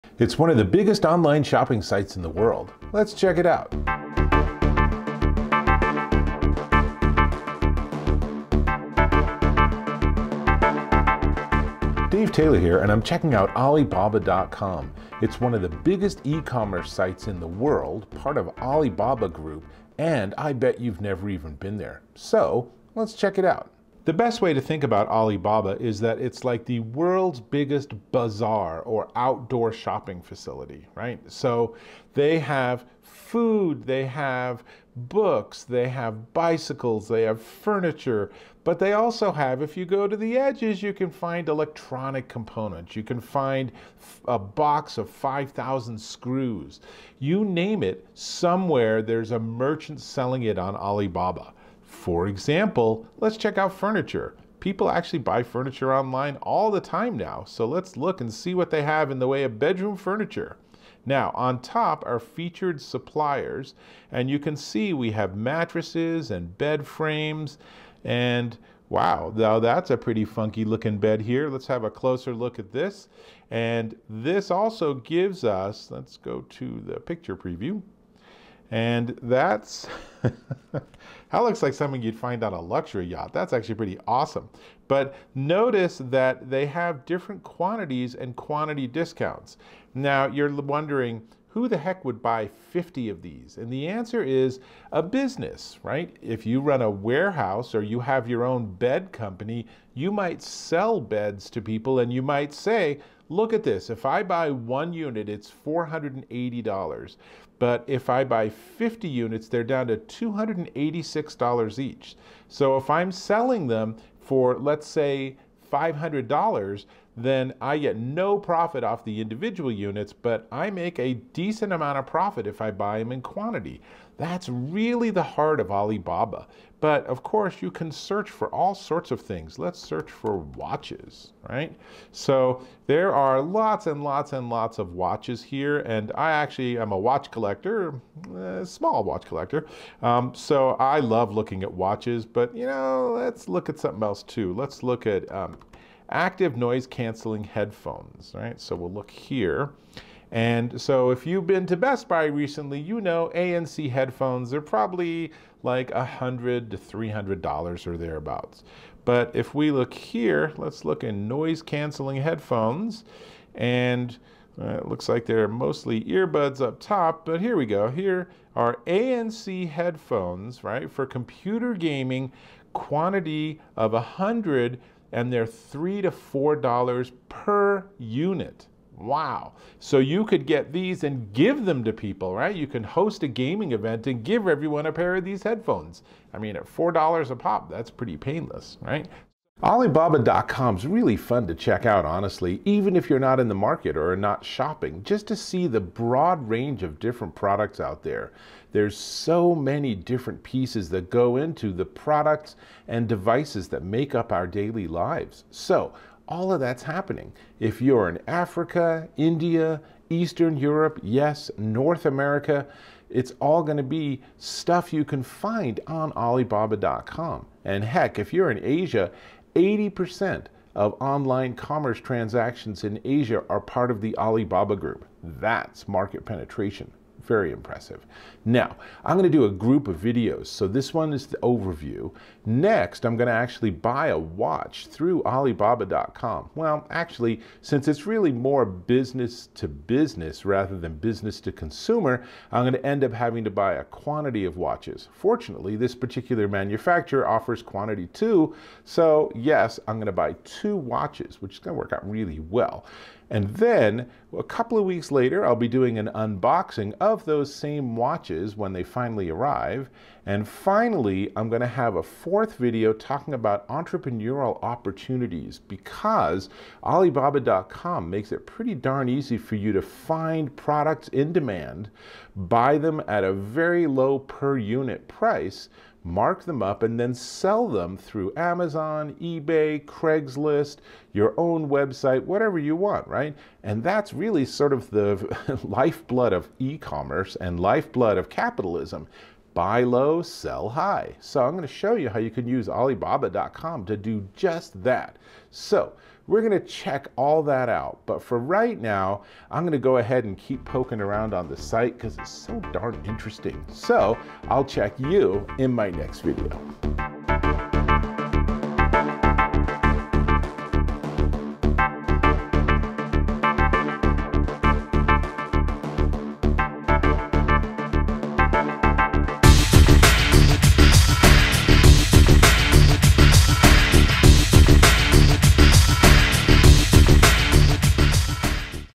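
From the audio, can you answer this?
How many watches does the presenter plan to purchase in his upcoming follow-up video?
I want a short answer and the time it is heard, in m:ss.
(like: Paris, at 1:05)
2, at 4:10.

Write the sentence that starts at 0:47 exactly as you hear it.
You name it, somewhere there's a merchant selling it on Alibaba.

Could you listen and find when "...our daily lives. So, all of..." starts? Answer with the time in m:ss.
3:24.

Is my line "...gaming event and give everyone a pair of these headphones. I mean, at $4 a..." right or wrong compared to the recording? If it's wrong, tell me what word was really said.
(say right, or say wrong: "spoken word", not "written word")
right.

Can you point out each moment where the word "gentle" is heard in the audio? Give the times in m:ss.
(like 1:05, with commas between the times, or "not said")
not said.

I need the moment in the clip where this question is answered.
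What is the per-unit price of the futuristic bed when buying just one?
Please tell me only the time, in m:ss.
1:45.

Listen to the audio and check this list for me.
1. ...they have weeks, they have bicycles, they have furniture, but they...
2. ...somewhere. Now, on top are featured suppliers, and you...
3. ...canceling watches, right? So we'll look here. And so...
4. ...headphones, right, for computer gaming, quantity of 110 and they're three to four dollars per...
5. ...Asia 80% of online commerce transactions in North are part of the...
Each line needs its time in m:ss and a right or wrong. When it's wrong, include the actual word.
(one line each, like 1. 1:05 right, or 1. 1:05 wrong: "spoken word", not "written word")
1. 0:33 wrong: "books", not "weeks"
2. 0:59 wrong: "furniture", not "somewhere"
3. 2:26 wrong: "headphones", not "watches"
4. 2:49 wrong: "100", not "110"
5. 3:38 wrong: "Asia", not "North".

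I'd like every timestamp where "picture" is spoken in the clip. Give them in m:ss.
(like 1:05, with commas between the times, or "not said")
1:17.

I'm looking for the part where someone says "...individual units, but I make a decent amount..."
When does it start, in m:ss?
1:59.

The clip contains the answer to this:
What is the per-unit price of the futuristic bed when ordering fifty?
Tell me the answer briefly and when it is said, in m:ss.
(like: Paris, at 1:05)
$286, at 1:49.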